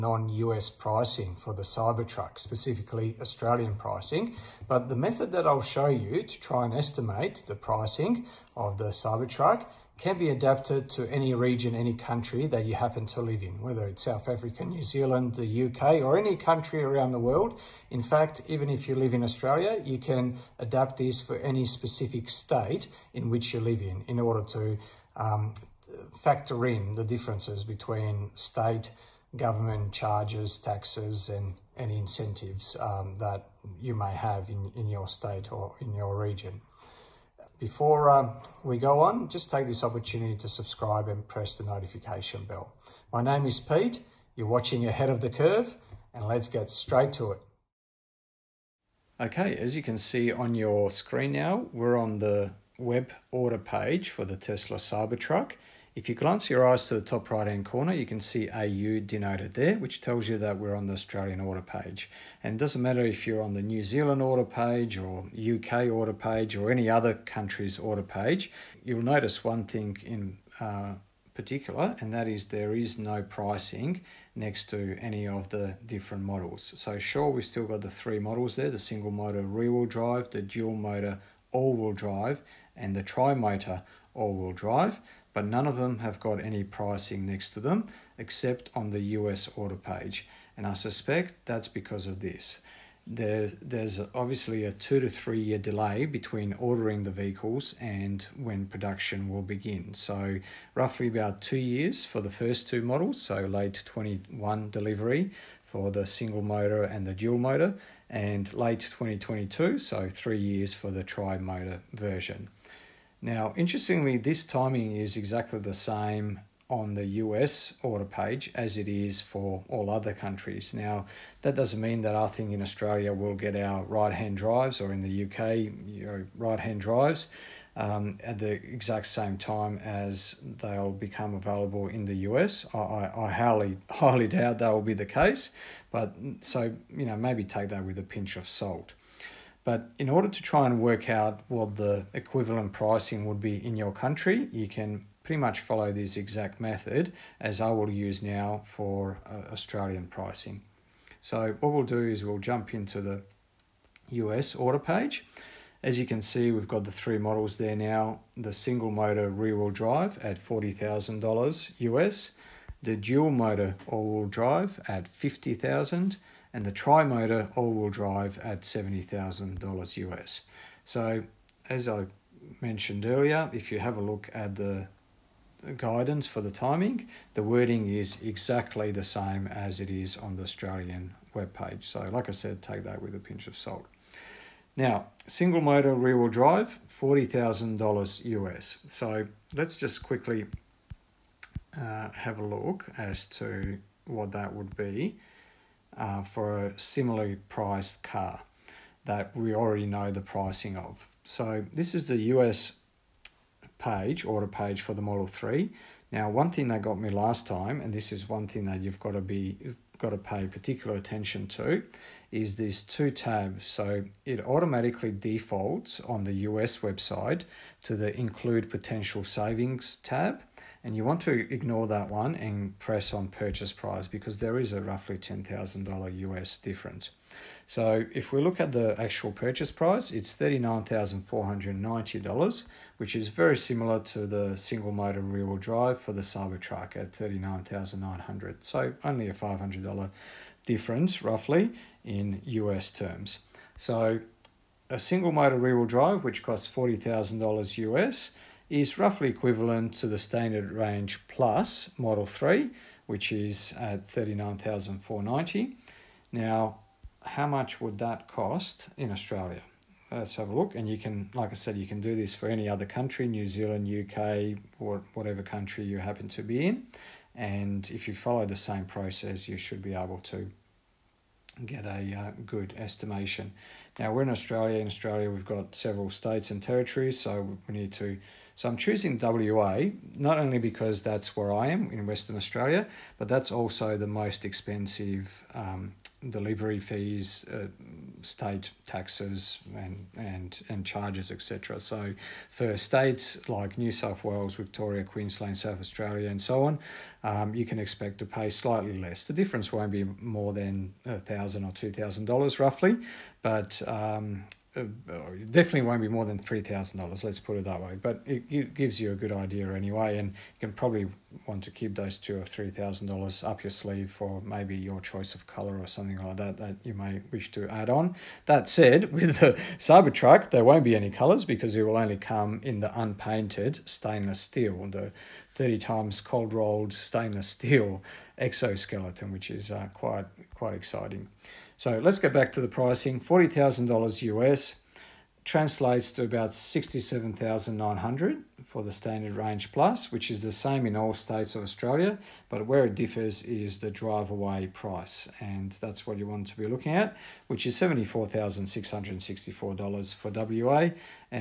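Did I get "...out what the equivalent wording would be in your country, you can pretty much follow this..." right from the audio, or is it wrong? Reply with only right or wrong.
wrong.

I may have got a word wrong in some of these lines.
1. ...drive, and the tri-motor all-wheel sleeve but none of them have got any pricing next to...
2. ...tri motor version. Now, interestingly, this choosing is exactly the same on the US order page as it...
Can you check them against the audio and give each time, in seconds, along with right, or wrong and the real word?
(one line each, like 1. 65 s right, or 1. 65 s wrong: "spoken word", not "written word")
1. 81 s wrong: "drive", not "sleeve"
2. 111 s wrong: "timing", not "choosing".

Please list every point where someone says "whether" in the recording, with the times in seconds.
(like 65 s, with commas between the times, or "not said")
13 s.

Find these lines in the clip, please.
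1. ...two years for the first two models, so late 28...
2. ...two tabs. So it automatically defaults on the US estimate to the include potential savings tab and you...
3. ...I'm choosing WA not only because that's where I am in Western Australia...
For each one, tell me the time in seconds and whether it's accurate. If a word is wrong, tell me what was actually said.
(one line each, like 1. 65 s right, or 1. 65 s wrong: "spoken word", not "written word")
1. 101 s wrong: "21", not "28"
2. 212 s wrong: "website", not "estimate"
3. 278 s right.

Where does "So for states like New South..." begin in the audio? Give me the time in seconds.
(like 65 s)
291 s.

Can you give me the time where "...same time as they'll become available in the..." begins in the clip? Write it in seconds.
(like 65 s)
129 s.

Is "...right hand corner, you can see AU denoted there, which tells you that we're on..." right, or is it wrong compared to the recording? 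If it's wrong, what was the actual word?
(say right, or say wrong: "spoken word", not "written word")
right.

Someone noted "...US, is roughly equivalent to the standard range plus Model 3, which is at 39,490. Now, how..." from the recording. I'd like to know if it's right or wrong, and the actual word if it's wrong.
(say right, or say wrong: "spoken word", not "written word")
right.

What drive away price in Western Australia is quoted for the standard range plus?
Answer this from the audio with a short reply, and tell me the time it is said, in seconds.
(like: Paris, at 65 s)
$74,664, at 347 s.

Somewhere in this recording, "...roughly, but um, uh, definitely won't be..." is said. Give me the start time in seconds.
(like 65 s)
302 s.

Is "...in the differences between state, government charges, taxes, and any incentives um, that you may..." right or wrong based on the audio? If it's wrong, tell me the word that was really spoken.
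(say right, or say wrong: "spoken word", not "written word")
right.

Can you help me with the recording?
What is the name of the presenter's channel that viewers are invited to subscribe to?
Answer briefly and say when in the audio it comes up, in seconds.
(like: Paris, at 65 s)
Ahead of the Curve, at 44 s.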